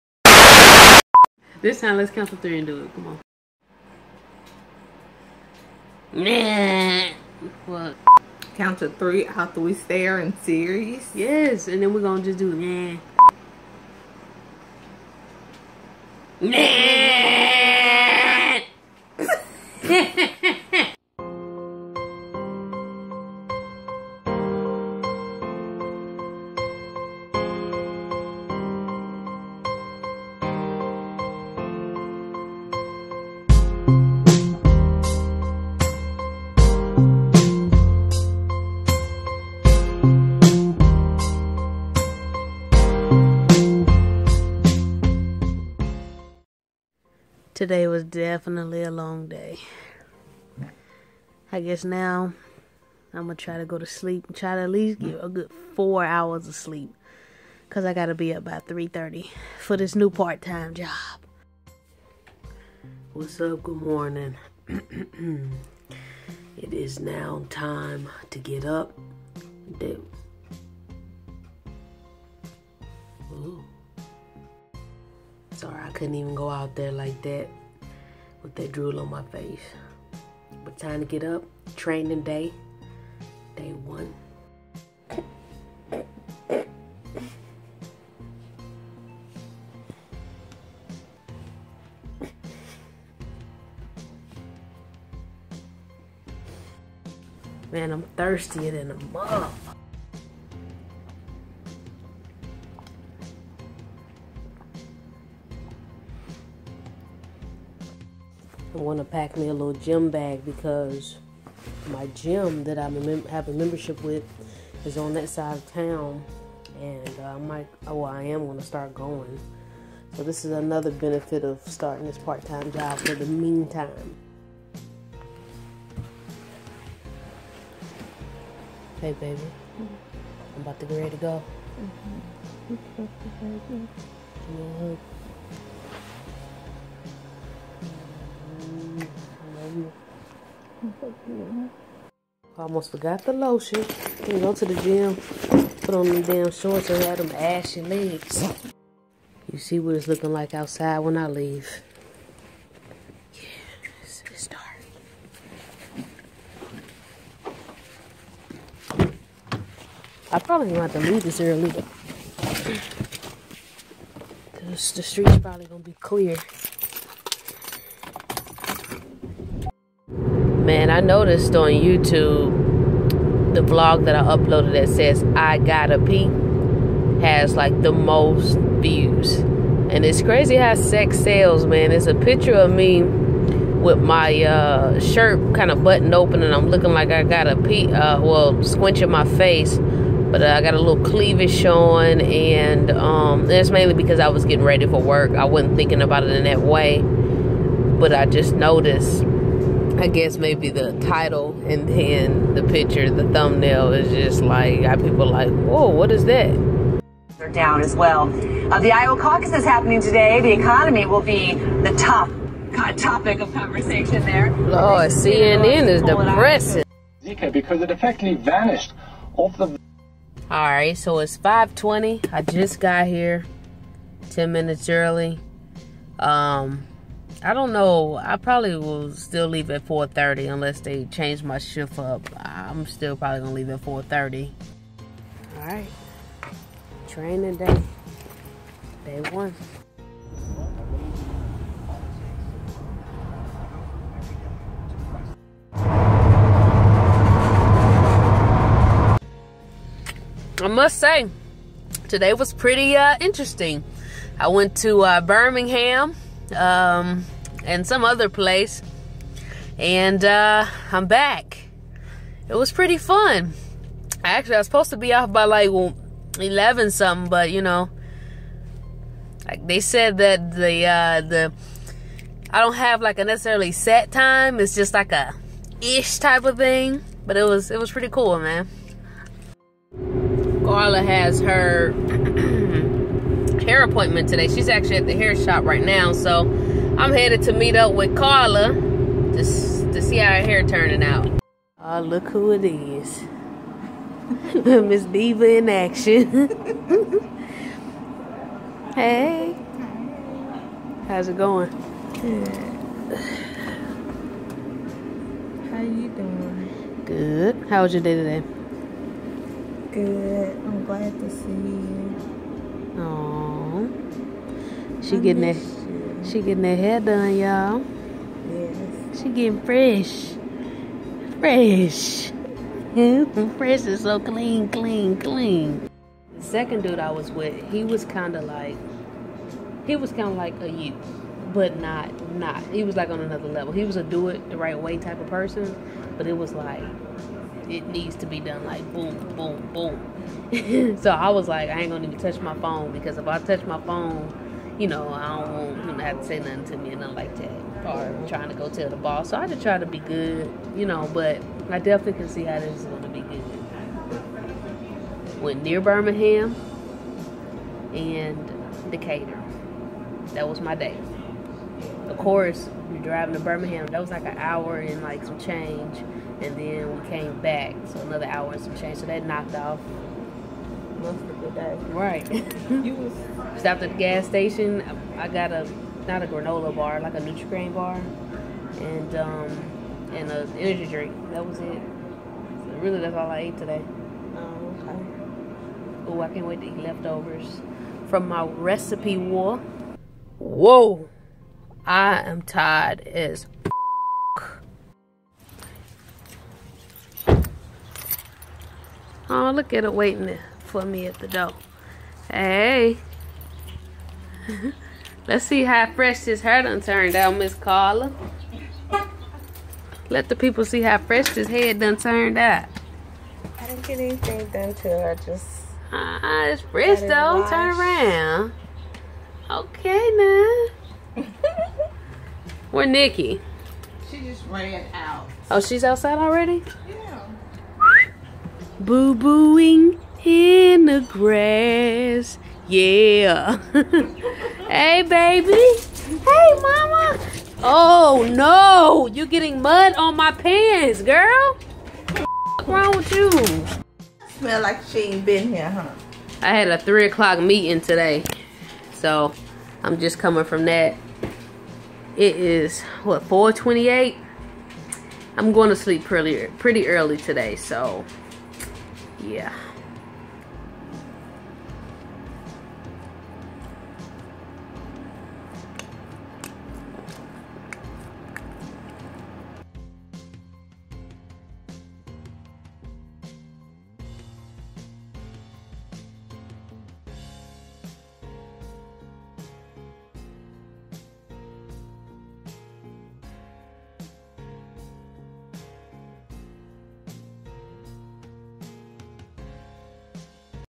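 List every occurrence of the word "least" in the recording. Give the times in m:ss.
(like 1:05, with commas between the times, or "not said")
0:54.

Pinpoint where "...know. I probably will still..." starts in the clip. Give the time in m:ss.
3:47.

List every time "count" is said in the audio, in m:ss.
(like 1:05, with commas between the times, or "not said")
0:02, 0:08.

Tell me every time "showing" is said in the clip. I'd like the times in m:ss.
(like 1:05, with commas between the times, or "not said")
3:11.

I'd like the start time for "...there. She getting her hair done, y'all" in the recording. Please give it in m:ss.
5:15.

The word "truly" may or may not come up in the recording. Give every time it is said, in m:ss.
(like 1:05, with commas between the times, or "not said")
not said.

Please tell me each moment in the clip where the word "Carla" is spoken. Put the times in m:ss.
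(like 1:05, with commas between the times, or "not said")
4:40, 4:48, 6:47.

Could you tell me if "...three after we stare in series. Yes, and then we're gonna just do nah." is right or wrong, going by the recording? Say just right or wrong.
right.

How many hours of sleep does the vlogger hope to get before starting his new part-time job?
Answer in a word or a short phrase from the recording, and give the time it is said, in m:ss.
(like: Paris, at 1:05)
4, at 0:55.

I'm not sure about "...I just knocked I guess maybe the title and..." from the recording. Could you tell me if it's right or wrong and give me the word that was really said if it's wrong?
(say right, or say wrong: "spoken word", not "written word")
wrong: "noticed", not "knocked".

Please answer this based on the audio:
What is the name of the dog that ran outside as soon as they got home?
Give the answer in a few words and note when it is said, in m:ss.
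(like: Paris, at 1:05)
Nikki, at 7:02.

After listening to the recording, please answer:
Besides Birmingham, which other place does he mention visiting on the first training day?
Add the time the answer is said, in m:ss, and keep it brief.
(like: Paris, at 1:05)
Decatur, at 5:58.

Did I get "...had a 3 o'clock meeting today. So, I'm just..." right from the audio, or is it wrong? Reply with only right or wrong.
right.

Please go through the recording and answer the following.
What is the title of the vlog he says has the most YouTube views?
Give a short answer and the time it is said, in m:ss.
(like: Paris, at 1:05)
I gotta pee, at 2:55.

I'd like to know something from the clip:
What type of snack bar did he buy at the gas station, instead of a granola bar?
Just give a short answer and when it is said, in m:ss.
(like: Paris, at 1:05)
Nutri-Grain bar, at 6:17.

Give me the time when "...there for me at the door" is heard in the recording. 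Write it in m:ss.
6:40.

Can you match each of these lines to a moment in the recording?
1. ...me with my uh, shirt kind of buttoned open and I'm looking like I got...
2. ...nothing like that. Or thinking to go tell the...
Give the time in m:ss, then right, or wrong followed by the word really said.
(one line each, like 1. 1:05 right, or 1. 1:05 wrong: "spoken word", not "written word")
1. 3:02 right
2. 5:47 wrong: "trying", not "thinking".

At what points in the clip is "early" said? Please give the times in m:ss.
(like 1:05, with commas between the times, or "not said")
2:41, 3:44, 7:36.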